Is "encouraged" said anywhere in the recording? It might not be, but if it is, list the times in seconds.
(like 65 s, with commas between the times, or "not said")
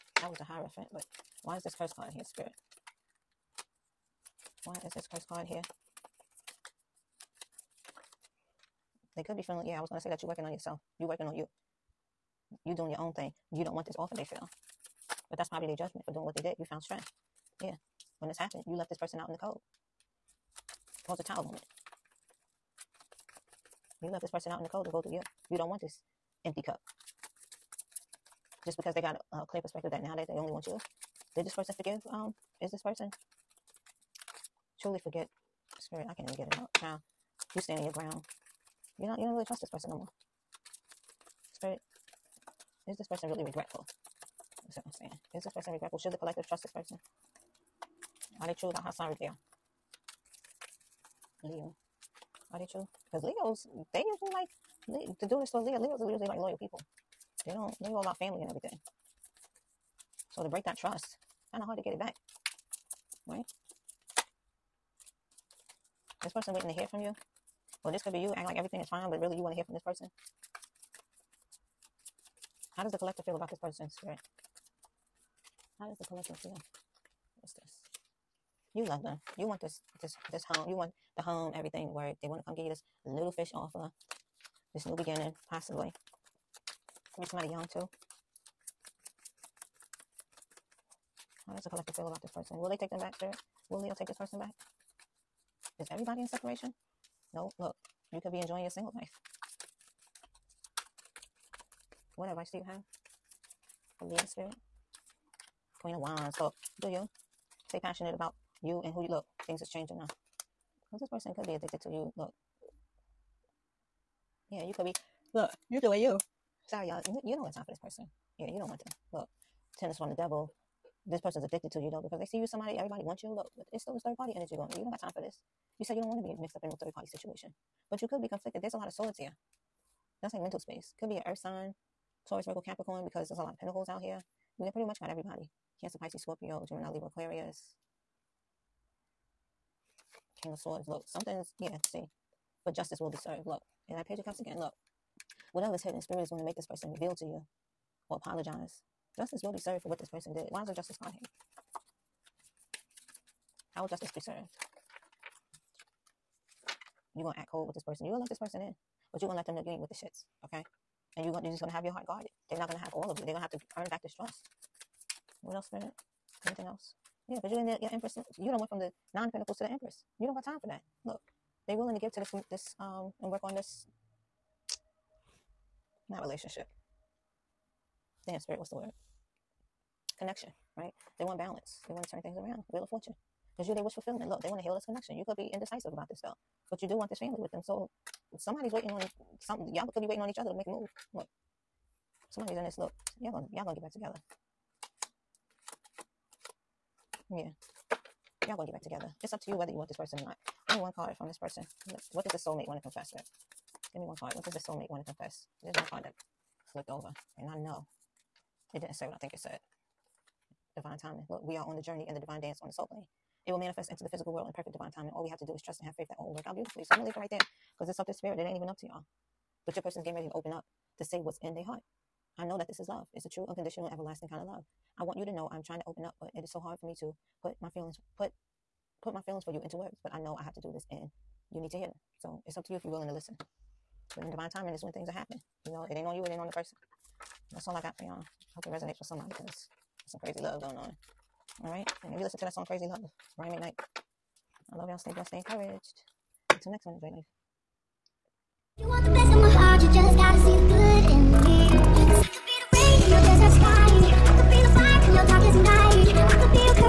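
245 s.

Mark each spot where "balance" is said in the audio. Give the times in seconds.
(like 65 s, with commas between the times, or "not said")
181 s.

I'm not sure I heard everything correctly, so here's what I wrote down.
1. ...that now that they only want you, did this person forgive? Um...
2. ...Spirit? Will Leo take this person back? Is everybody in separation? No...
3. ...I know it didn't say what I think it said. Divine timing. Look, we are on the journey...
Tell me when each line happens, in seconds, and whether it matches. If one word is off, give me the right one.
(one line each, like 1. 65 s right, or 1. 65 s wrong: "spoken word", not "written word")
1. 29 s right
2. 93 s right
3. 207 s right.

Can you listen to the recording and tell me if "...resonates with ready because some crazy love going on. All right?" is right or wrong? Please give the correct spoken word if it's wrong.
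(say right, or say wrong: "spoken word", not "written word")
wrong: "somebody", not "ready".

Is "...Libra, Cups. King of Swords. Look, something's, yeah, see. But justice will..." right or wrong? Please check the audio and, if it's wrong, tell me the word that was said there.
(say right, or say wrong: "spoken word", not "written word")
wrong: "Aquarius", not "Cups".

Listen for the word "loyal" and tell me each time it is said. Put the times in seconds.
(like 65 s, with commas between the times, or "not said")
56 s.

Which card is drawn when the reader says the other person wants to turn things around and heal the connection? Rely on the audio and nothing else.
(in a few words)
Wheel of Fortune.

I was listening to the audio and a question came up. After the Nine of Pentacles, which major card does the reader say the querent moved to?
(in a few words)
The Empress.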